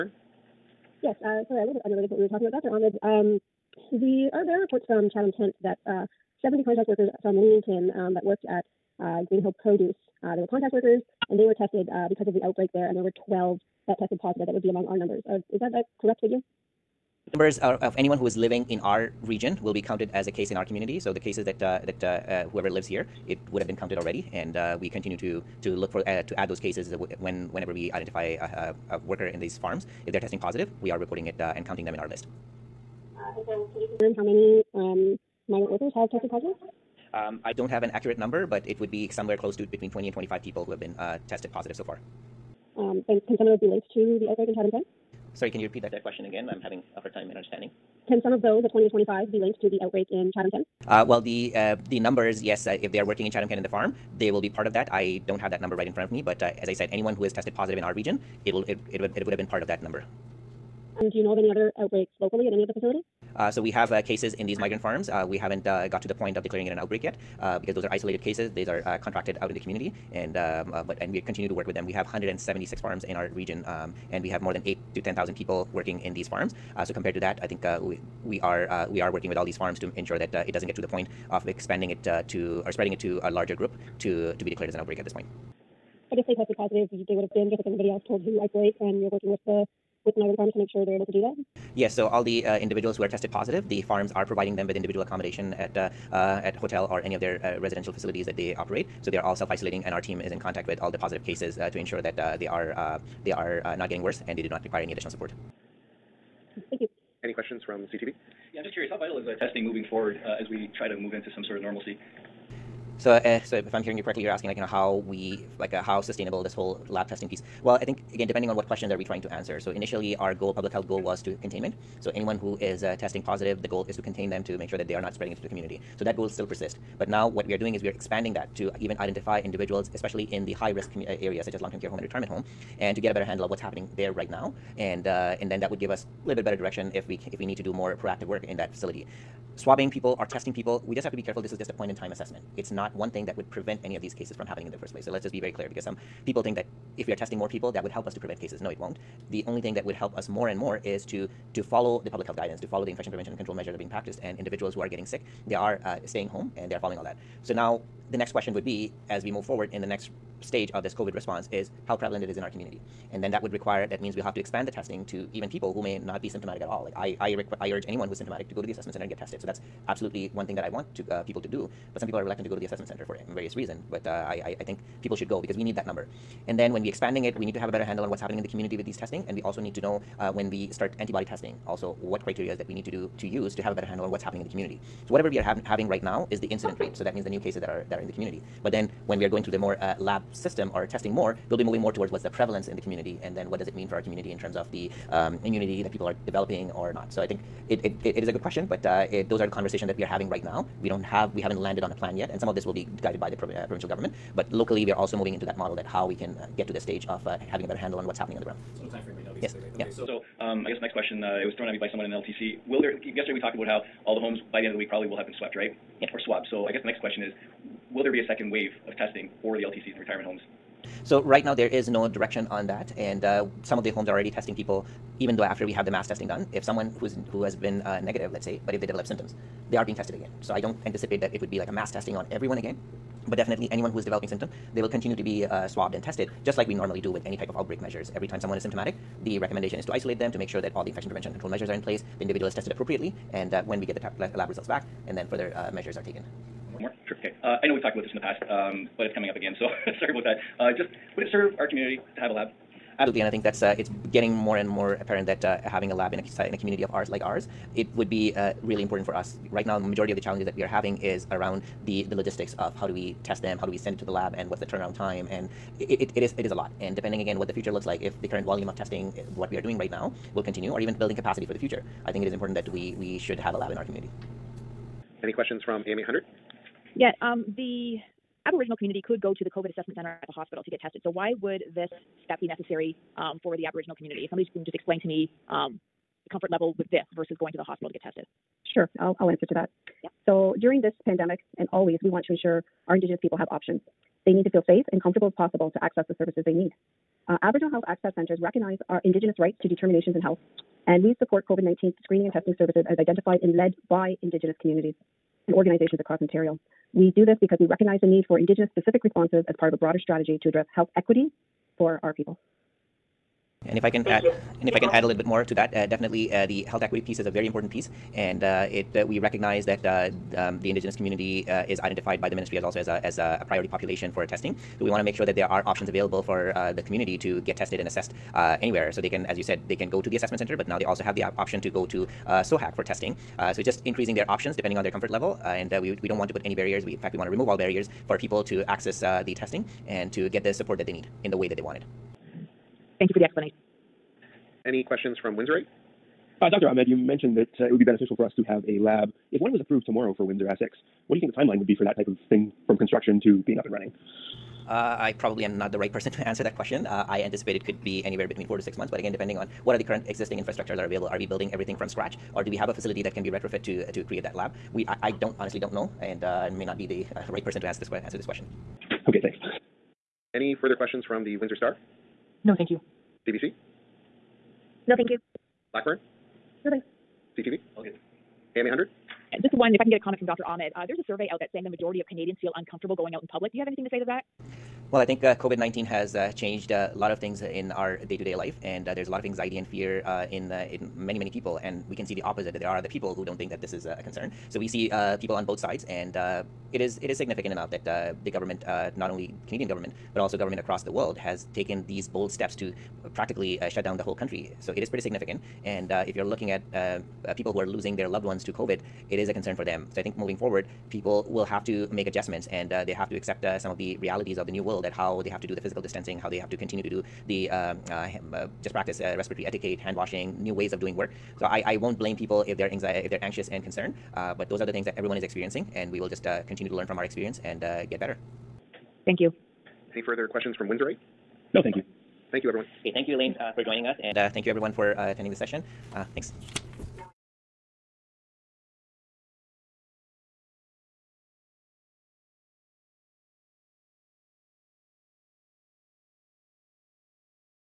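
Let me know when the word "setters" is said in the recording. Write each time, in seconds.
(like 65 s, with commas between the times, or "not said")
not said.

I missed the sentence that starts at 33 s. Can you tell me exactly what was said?
Okay, so can you confirm how many um, migrant workers have tested positive?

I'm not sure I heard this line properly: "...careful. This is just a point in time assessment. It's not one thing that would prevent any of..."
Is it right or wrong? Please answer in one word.
right.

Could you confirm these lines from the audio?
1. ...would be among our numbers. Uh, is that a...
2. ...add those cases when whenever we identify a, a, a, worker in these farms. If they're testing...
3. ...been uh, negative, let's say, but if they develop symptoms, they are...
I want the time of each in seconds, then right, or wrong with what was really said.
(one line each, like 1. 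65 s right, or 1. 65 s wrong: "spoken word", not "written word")
1. 14 s right
2. 26 s right
3. 227 s right.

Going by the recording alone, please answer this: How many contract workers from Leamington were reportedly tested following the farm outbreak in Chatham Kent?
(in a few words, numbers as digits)
70.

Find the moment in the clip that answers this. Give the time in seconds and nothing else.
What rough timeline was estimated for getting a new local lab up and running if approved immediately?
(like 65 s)
358 s.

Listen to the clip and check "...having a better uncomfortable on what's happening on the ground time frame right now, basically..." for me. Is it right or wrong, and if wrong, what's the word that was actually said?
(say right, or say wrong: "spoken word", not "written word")
wrong: "handle", not "uncomfortable".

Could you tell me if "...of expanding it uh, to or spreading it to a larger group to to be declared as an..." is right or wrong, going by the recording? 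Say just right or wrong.
right.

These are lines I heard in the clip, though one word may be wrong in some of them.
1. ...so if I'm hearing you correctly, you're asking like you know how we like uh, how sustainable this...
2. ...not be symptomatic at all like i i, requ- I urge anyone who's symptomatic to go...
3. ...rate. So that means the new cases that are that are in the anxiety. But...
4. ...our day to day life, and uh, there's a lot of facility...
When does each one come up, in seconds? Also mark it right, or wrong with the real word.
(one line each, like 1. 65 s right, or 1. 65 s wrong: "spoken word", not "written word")
1. 113 s right
2. 165 s right
3. 186 s wrong: "community", not "anxiety"
4. 387 s wrong: "anxiety", not "facility".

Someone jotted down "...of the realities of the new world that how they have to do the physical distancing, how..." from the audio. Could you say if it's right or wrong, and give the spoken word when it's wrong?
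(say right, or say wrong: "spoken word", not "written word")
right.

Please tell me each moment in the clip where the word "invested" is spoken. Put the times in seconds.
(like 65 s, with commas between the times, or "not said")
not said.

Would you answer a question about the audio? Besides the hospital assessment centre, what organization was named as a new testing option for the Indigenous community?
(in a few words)
SOHAC.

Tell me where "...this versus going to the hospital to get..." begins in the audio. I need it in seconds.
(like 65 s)
286 s.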